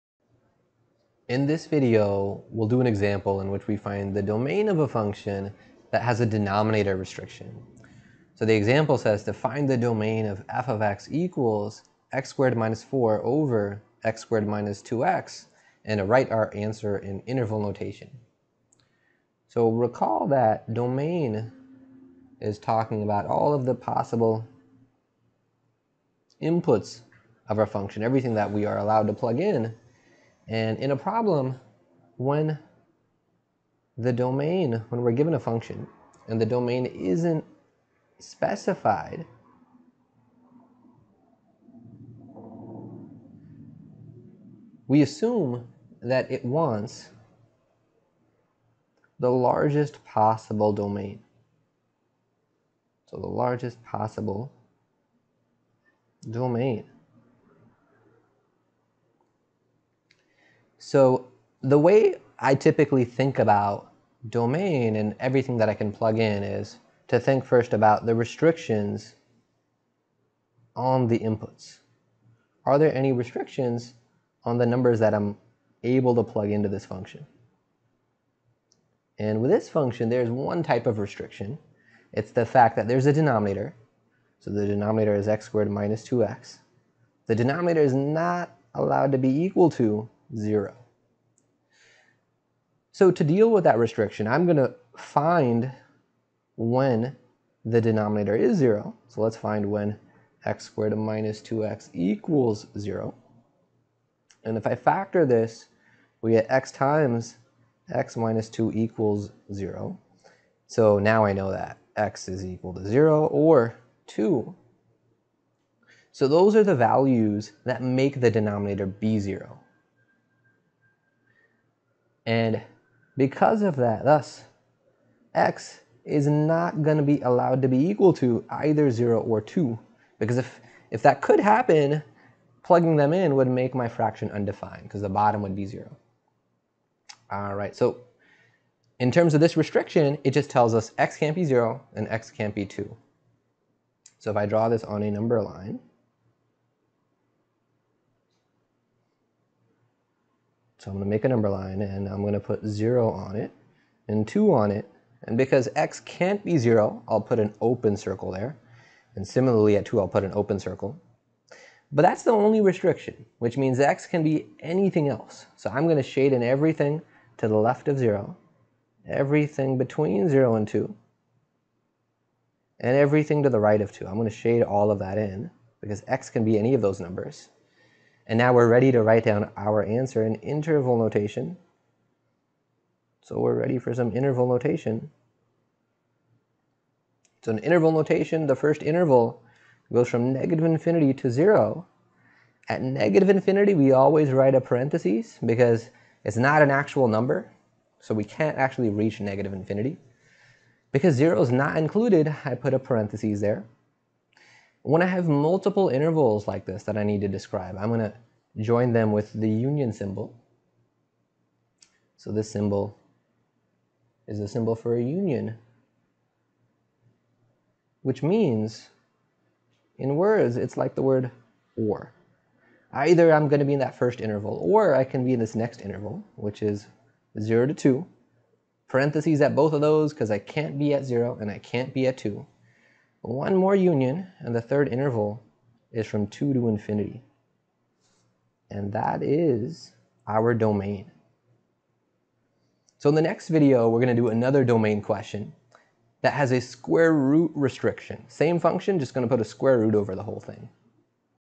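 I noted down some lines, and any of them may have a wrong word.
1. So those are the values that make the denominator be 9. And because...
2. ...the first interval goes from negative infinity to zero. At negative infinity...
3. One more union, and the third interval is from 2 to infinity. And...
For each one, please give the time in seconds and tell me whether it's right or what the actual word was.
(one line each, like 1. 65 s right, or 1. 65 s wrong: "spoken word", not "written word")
1. 116 s wrong: "0", not "9"
2. 188 s right
3. 233 s right.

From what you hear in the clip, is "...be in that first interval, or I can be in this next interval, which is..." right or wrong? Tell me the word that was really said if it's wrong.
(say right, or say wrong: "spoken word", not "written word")
right.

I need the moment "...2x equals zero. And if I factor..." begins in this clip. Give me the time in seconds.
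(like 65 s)
101 s.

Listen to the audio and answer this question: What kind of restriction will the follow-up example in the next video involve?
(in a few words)
square root restriction.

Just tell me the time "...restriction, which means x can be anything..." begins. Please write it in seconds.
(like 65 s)
162 s.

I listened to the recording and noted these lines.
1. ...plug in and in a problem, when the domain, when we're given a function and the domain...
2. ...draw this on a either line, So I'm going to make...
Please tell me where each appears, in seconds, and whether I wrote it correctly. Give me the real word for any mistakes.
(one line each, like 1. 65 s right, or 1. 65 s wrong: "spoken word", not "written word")
1. 29 s right
2. 144 s wrong: "number", not "either".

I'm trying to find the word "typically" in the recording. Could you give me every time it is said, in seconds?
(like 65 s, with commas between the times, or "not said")
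62 s.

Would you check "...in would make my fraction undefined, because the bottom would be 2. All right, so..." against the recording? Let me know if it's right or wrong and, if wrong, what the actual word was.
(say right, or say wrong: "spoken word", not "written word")
wrong: "0", not "2".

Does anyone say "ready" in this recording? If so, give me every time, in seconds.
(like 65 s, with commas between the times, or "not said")
178 s, 183 s.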